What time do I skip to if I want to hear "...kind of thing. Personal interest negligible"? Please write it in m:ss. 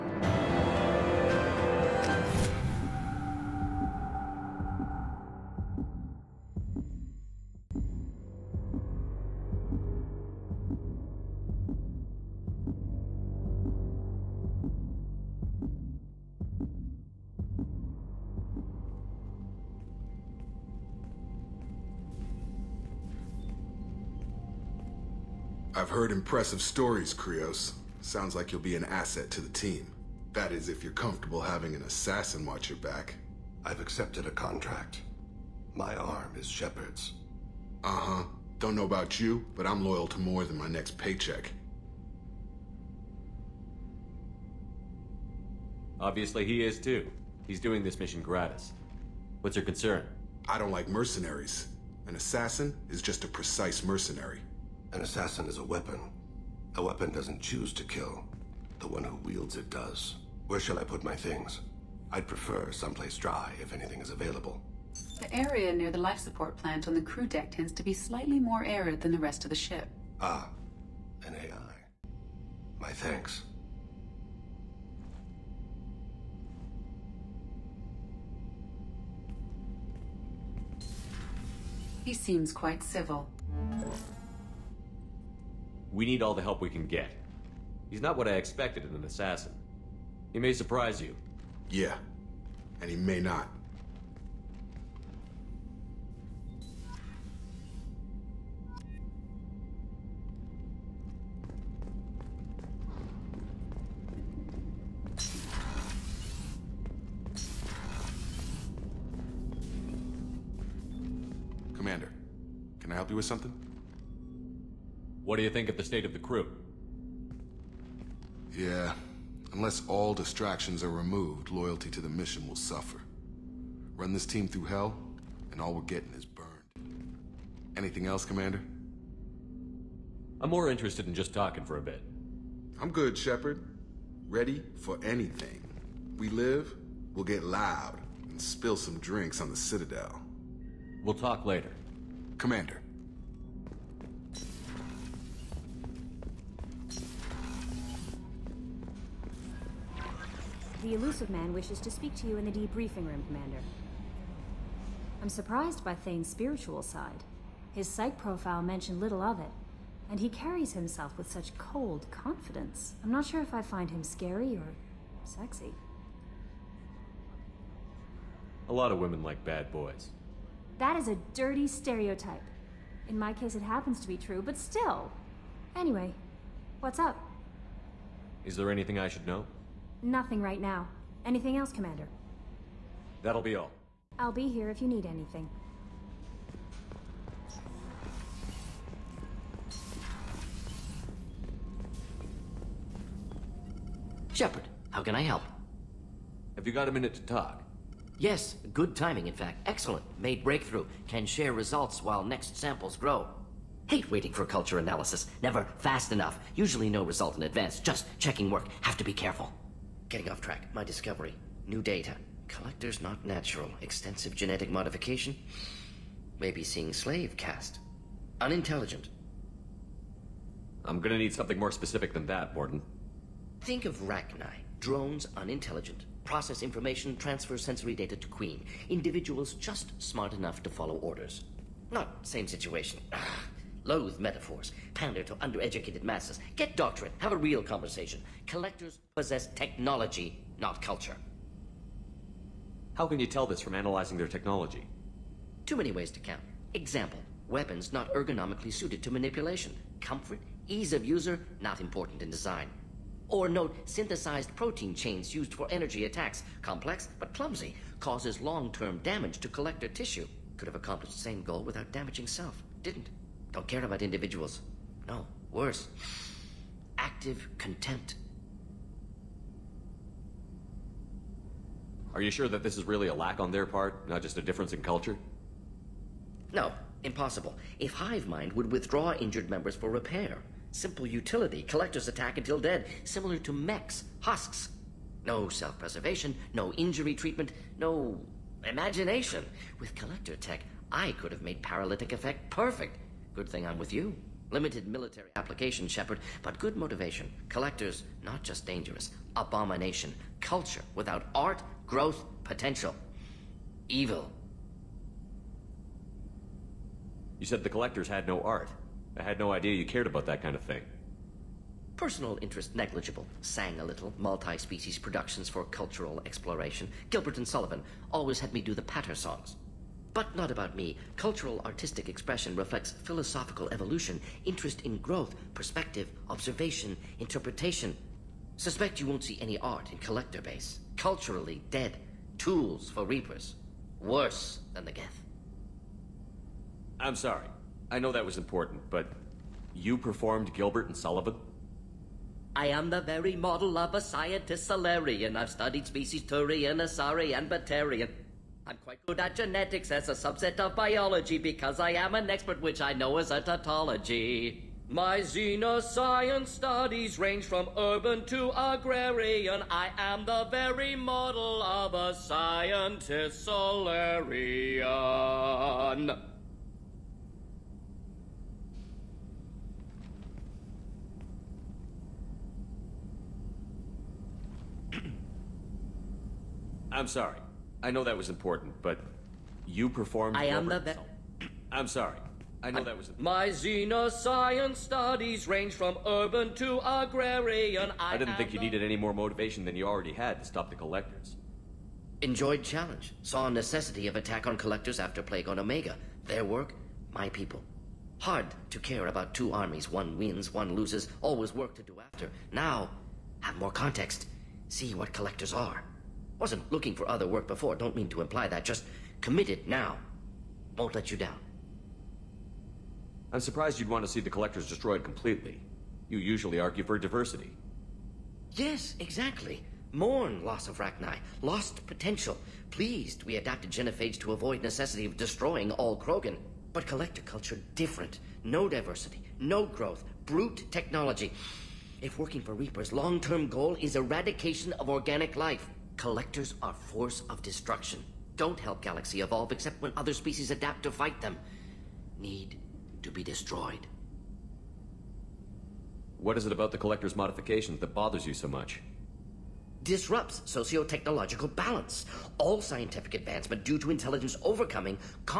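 5:10.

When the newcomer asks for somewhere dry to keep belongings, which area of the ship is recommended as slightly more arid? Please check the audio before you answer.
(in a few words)
Near the life support plant.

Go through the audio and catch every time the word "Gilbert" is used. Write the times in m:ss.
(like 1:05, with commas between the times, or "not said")
5:17, 5:40.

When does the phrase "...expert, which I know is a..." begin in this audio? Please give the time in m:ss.
5:52.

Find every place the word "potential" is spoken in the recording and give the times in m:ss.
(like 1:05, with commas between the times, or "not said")
5:02, 7:01.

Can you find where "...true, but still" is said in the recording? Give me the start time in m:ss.
2:54.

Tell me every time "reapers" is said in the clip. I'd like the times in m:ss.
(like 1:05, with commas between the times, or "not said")
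5:33, 7:12.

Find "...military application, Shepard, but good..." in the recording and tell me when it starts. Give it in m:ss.
4:54.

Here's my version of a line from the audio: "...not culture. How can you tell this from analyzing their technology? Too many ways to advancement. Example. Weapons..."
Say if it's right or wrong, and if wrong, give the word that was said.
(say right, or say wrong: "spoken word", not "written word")
wrong: "count", not "advancement".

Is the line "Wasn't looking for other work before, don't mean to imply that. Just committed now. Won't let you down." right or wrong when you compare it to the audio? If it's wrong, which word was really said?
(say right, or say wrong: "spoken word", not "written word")
right.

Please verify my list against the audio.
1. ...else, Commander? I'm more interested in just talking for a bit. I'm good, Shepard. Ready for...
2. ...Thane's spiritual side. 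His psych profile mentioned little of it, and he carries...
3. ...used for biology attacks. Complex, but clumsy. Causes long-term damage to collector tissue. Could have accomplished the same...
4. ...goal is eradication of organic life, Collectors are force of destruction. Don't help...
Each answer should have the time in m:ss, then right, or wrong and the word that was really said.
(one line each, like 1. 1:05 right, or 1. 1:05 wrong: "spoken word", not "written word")
1. 2:08 right
2. 2:35 right
3. 4:15 wrong: "energy", not "biology"
4. 7:13 right.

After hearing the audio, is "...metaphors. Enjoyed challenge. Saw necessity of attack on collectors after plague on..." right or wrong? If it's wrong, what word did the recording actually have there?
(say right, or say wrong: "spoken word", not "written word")
wrong: "collectors", not "metaphors".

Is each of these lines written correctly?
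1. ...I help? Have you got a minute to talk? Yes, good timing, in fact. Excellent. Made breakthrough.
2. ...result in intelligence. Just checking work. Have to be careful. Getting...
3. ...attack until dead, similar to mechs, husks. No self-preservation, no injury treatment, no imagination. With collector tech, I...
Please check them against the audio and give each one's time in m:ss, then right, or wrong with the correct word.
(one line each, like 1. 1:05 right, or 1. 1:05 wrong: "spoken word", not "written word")
1. 3:15 right
2. 3:27 wrong: "advance", not "intelligence"
3. 4:42 right.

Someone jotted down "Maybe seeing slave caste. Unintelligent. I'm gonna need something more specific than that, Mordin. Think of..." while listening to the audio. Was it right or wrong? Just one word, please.
right.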